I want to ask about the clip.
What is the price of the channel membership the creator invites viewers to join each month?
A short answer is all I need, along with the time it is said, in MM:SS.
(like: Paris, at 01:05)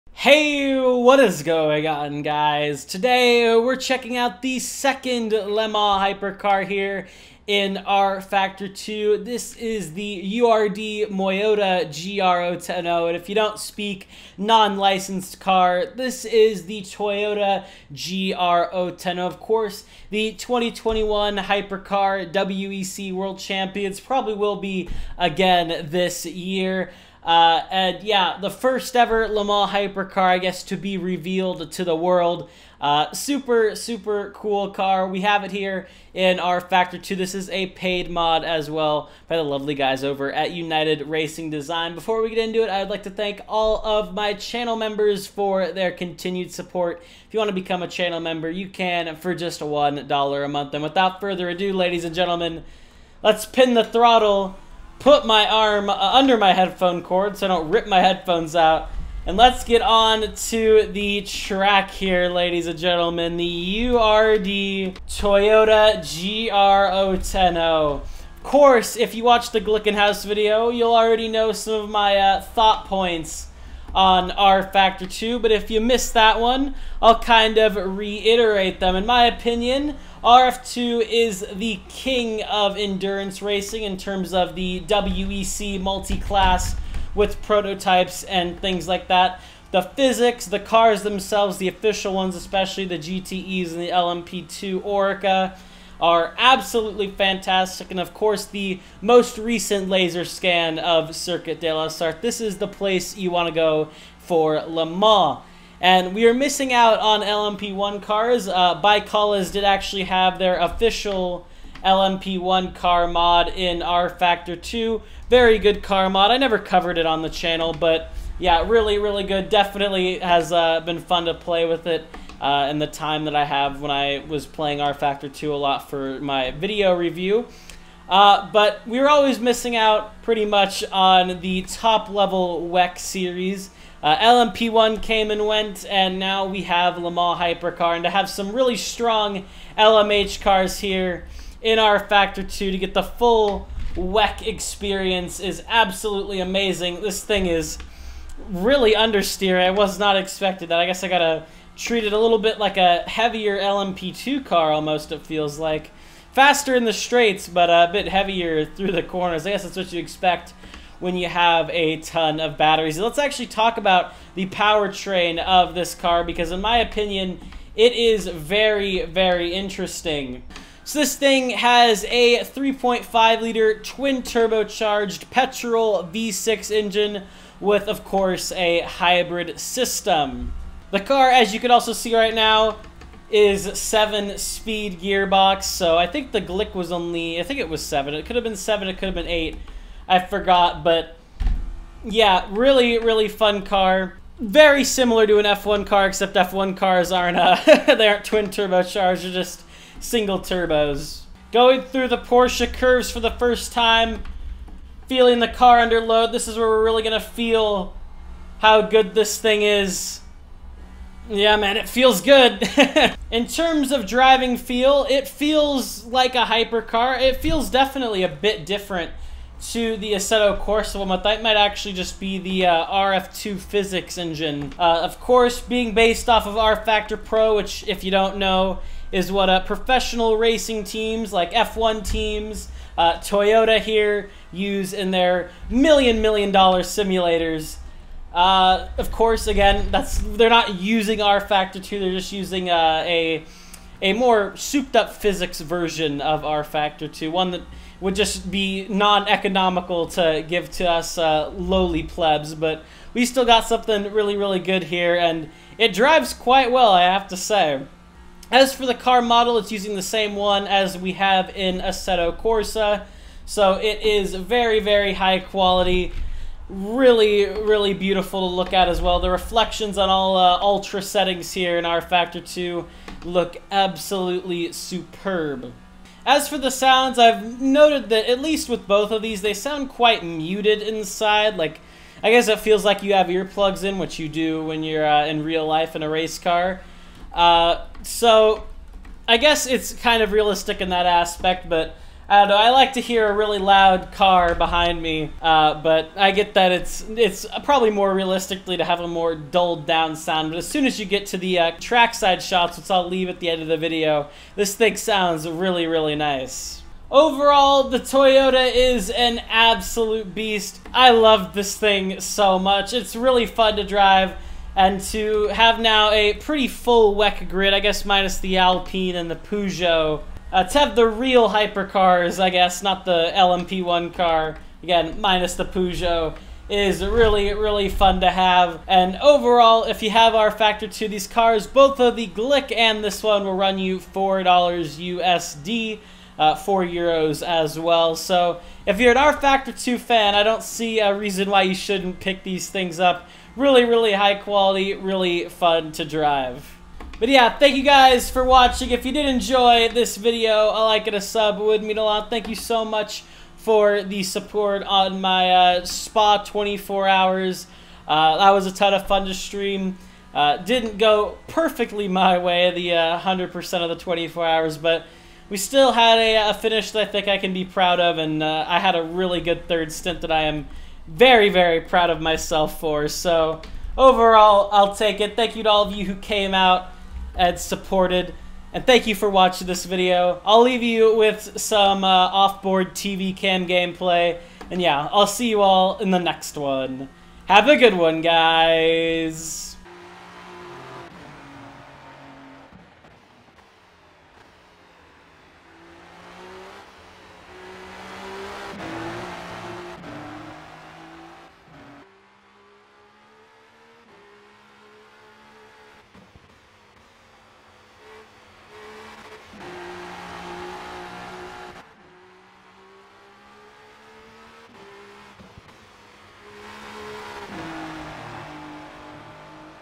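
$1, at 00:49.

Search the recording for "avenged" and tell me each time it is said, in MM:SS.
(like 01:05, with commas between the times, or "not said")
not said.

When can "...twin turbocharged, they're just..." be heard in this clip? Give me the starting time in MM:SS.
03:18.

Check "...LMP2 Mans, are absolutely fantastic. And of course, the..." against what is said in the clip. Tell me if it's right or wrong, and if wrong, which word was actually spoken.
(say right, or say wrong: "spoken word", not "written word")
wrong: "Oreca", not "Mans".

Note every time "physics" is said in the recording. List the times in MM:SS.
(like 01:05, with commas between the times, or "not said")
01:29, 03:43, 04:05.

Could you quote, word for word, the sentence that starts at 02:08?
Uh, but we were always missing out pretty much on the top level WEC series.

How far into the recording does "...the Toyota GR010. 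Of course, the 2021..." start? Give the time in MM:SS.
00:16.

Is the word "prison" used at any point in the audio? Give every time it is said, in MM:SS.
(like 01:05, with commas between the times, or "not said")
not said.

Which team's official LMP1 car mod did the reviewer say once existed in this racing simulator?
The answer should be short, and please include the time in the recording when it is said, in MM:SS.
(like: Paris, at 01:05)
ByKolles, at 01:48.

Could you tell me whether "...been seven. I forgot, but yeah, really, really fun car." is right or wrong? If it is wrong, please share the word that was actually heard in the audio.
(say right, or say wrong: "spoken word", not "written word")
wrong: "eight", not "seven".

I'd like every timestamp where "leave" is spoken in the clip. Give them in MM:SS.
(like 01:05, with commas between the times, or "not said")
05:03, 06:20.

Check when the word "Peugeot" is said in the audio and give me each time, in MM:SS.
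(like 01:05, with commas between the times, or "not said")
05:19, 05:25.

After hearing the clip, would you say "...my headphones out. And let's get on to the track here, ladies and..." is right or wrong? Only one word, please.
right.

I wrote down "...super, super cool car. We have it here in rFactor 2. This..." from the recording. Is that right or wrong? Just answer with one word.
right.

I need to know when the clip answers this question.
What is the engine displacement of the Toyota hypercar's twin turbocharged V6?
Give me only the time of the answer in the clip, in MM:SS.
02:52.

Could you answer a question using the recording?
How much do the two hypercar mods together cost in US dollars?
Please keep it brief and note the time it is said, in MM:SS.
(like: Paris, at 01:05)
$4, at 05:33.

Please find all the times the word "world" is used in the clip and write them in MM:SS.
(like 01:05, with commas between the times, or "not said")
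00:23, 00:31.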